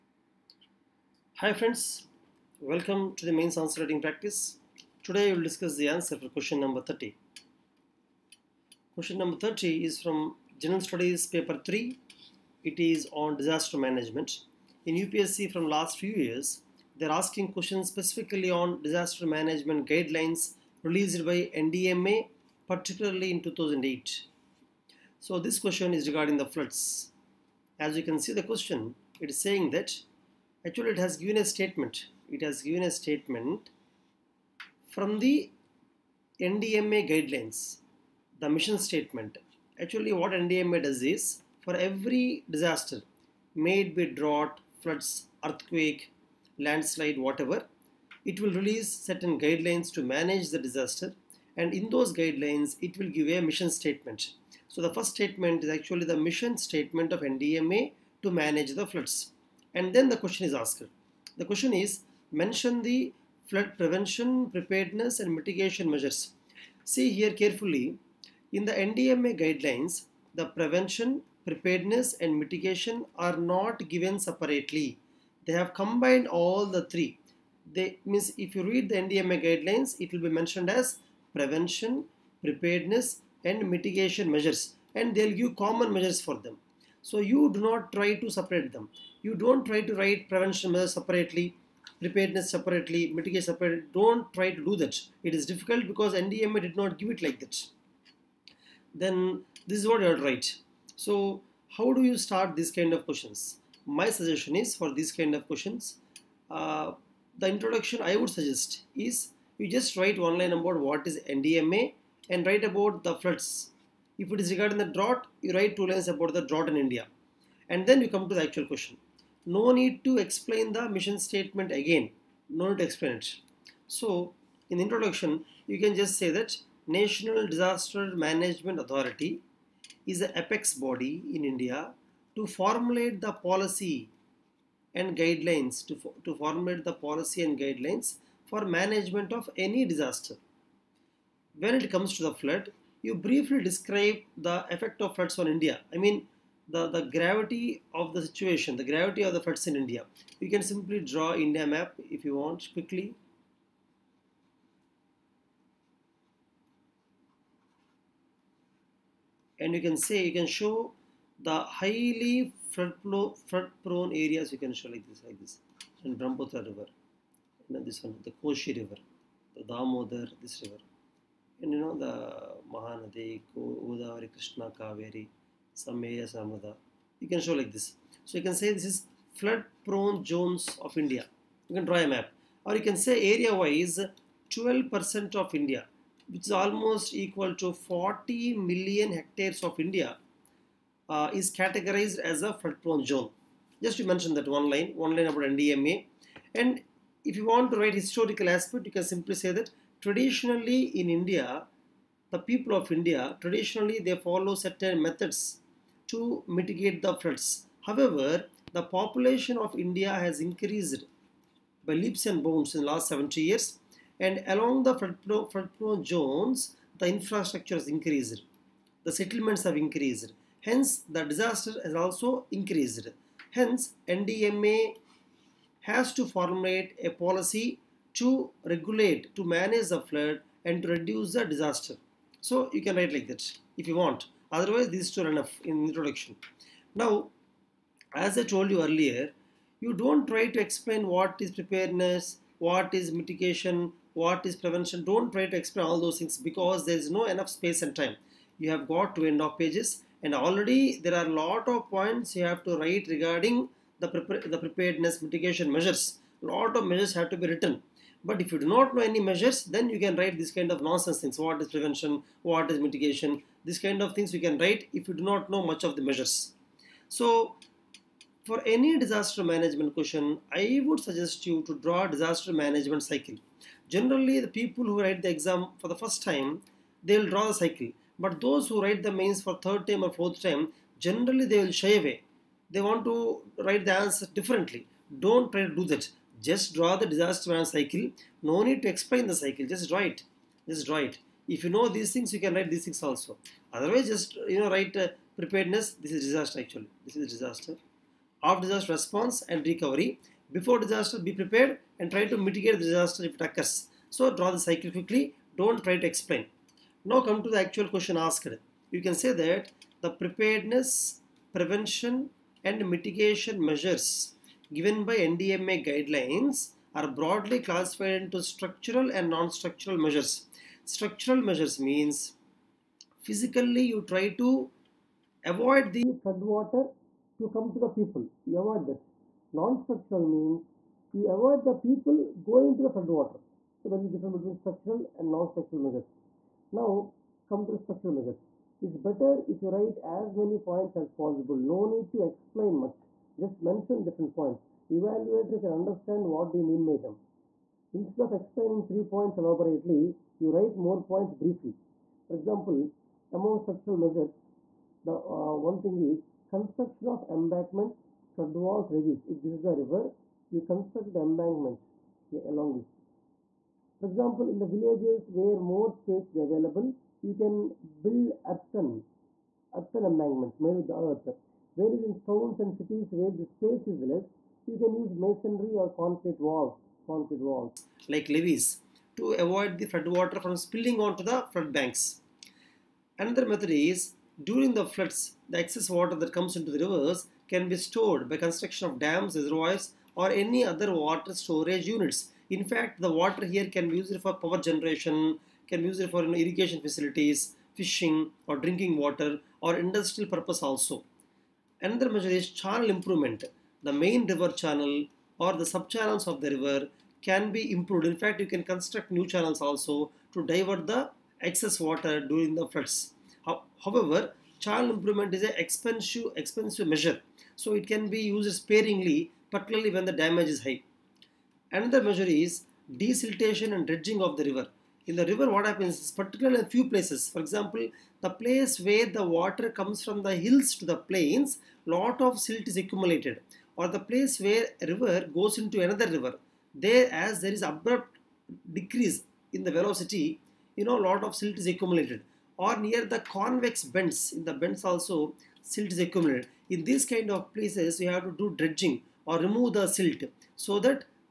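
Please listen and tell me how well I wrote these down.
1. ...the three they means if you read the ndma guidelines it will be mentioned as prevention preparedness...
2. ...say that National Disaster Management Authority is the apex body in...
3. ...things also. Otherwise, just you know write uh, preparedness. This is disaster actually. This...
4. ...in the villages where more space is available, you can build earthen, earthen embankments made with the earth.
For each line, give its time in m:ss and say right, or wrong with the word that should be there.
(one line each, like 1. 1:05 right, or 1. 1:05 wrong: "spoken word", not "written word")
1. 1:16 right
2. 2:06 right
3. 4:52 right
4. 6:04 right.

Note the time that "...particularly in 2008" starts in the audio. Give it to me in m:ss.
0:22.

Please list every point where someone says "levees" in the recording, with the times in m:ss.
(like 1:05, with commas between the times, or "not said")
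5:58, 6:18.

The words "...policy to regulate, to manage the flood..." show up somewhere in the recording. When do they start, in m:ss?
3:47.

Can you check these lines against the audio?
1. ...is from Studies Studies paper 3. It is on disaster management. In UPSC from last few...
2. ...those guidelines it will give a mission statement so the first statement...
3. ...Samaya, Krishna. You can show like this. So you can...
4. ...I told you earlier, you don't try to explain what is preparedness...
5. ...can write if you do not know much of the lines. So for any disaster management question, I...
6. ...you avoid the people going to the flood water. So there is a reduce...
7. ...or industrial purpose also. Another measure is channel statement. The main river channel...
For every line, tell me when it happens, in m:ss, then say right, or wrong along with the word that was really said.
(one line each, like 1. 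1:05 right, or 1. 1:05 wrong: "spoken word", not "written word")
1. 0:09 wrong: "General", not "Studies"
2. 0:51 right
3. 2:55 wrong: "Samada", not "Krishna"
4. 3:58 right
5. 4:24 wrong: "measures", not "lines"
6. 5:31 wrong: "difference", not "reduce"
7. 6:39 wrong: "improvement", not "statement".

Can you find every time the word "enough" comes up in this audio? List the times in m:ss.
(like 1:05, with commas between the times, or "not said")
3:55, 4:07.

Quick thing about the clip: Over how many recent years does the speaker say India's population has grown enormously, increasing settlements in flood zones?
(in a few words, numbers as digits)
70 years.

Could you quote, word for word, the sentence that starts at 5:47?
Instead of explaining three points elaborately, you write more points briefly.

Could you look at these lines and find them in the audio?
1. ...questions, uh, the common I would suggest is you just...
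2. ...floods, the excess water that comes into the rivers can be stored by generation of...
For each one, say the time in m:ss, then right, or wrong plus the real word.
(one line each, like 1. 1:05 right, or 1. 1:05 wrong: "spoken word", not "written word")
1. 1:45 wrong: "introduction", not "common"
2. 6:24 wrong: "construction", not "generation".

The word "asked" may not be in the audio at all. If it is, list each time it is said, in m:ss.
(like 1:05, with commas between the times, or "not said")
1:00, 5:08.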